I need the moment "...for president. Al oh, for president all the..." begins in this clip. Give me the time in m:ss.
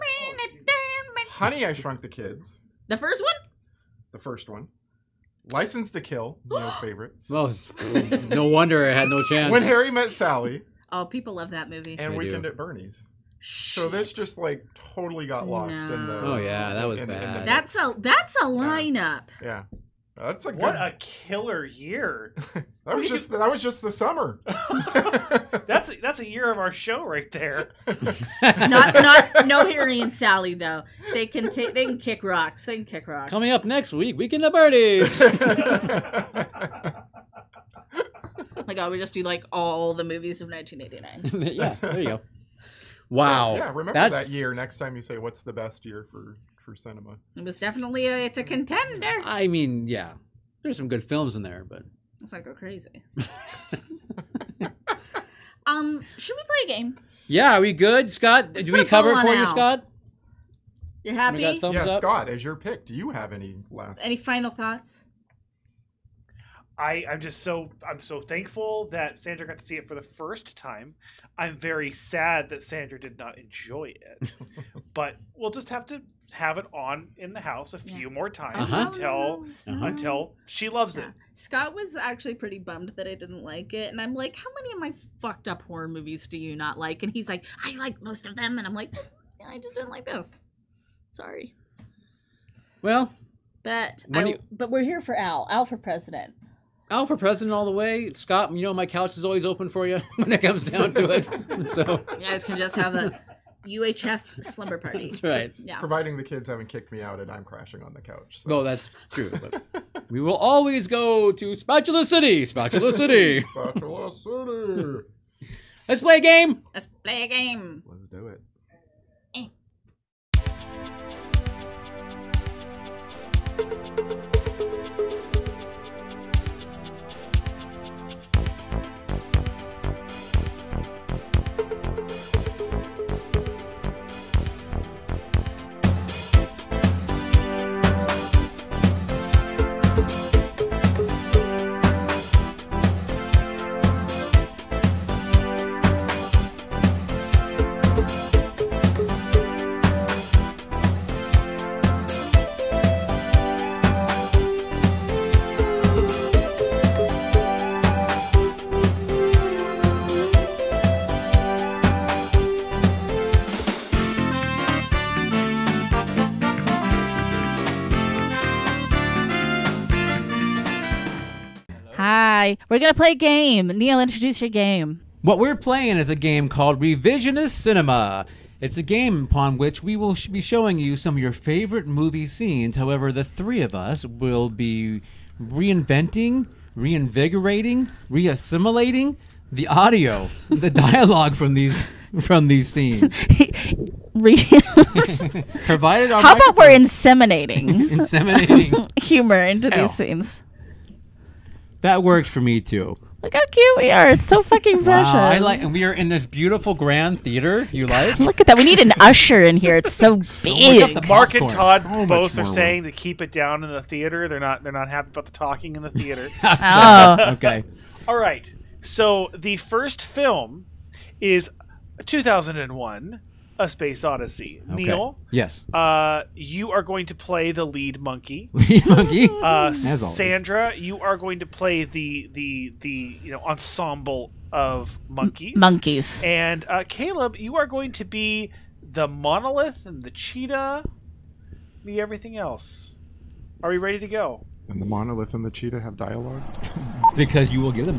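1:35.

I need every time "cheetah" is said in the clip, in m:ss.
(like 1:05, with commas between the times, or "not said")
4:00, 4:05.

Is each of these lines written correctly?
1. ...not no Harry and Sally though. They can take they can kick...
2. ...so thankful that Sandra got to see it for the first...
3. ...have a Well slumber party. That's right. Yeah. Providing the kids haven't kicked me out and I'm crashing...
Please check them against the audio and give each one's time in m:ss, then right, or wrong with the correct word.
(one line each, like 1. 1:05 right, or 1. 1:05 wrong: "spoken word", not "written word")
1. 0:28 right
2. 1:07 right
3. 1:42 wrong: "UHF", not "Well".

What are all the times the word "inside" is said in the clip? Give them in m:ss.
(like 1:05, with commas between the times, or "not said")
not said.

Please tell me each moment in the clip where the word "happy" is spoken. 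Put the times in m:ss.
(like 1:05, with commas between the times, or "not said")
1:01, 3:34.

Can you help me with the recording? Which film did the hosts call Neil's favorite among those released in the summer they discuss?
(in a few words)
License to Kill.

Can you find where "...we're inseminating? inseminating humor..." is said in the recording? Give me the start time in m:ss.
3:16.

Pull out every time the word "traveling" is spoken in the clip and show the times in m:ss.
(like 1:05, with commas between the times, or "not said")
not said.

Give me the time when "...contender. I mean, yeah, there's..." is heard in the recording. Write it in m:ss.
0:48.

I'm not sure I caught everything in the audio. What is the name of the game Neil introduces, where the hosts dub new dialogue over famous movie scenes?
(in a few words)
Revisionist Cinema.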